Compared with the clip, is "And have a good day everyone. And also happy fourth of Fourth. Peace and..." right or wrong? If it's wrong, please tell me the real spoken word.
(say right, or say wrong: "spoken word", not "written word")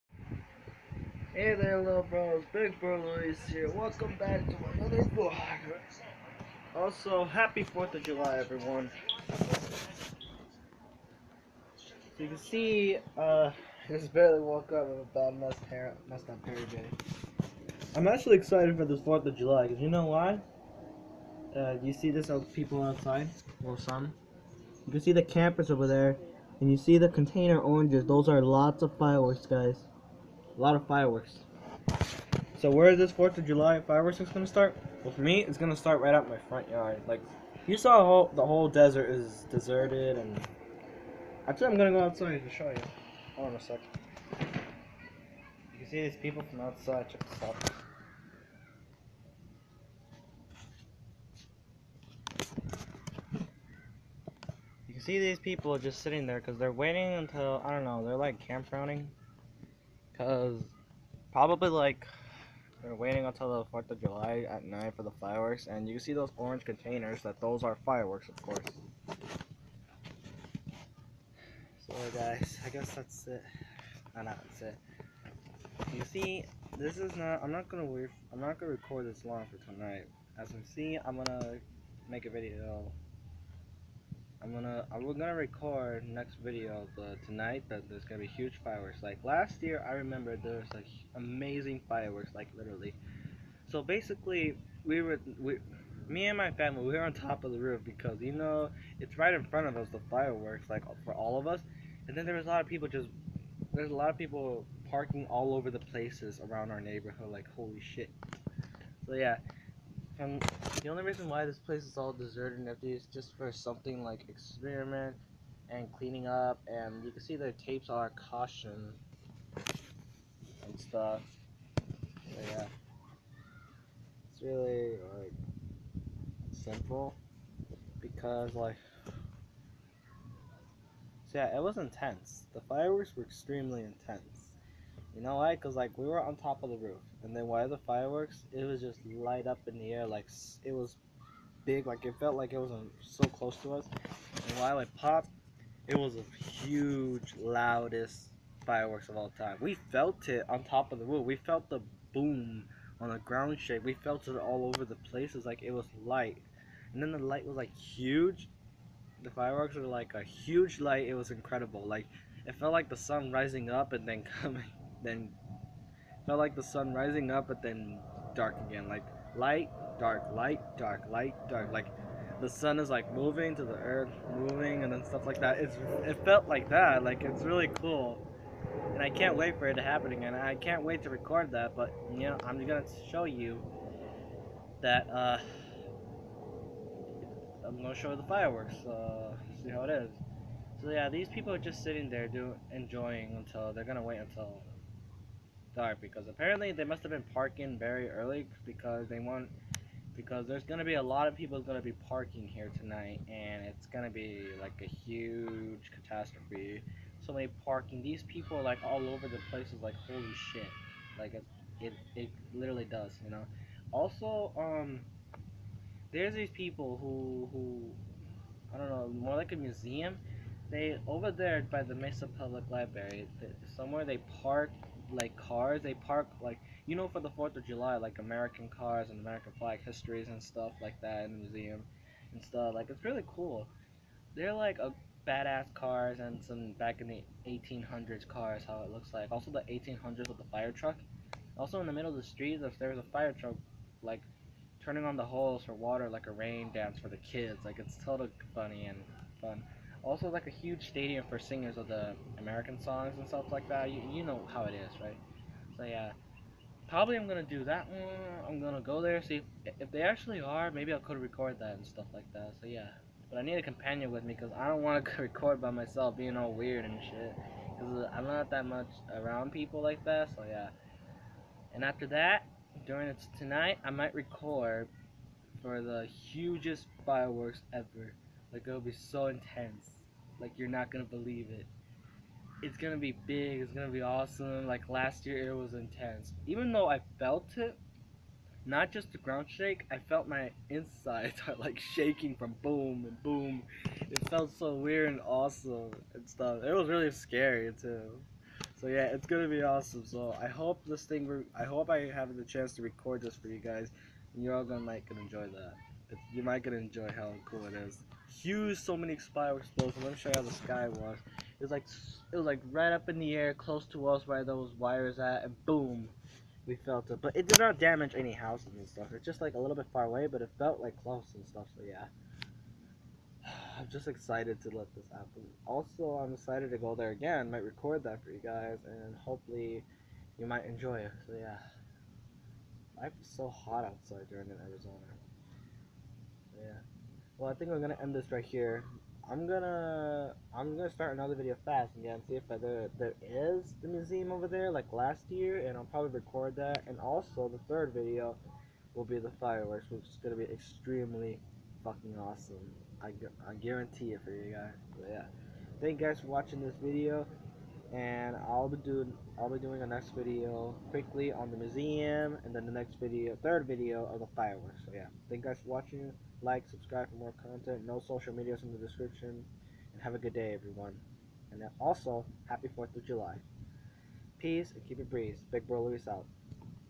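wrong: "July", not "Fourth".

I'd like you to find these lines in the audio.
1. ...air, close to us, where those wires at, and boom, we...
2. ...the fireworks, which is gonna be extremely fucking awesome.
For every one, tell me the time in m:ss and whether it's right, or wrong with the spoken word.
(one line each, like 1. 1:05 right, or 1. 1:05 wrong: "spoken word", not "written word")
1. 5:13 right
2. 5:49 right.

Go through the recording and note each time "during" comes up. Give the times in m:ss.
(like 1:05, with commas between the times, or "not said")
4:32, 5:34.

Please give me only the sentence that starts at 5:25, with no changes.
Also, I'm excited to go there again.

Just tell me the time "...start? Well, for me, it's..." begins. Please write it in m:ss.
0:34.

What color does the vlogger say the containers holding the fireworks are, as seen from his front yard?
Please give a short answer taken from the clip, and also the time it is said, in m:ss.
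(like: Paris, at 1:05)
Orange, at 0:27.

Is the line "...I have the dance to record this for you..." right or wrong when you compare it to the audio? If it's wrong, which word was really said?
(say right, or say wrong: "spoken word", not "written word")
wrong: "chance", not "dance".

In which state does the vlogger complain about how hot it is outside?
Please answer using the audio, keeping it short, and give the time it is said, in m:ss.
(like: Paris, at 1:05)
Arizona, at 5:34.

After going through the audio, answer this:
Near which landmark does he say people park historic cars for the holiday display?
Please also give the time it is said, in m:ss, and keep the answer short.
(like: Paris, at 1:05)
Mesa Public Library, at 3:41.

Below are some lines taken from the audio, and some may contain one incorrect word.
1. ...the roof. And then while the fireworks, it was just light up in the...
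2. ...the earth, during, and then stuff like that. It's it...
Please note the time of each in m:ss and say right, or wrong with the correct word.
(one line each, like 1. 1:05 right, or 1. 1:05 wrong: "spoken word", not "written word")
1. 2:16 right
2. 2:53 wrong: "moving", not "during".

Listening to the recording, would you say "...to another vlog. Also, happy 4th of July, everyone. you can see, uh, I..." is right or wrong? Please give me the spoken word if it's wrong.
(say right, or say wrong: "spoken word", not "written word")
right.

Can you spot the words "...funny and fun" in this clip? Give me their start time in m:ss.
4:08.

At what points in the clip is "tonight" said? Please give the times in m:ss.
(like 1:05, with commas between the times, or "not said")
1:19, 1:27, 3:22, 4:33.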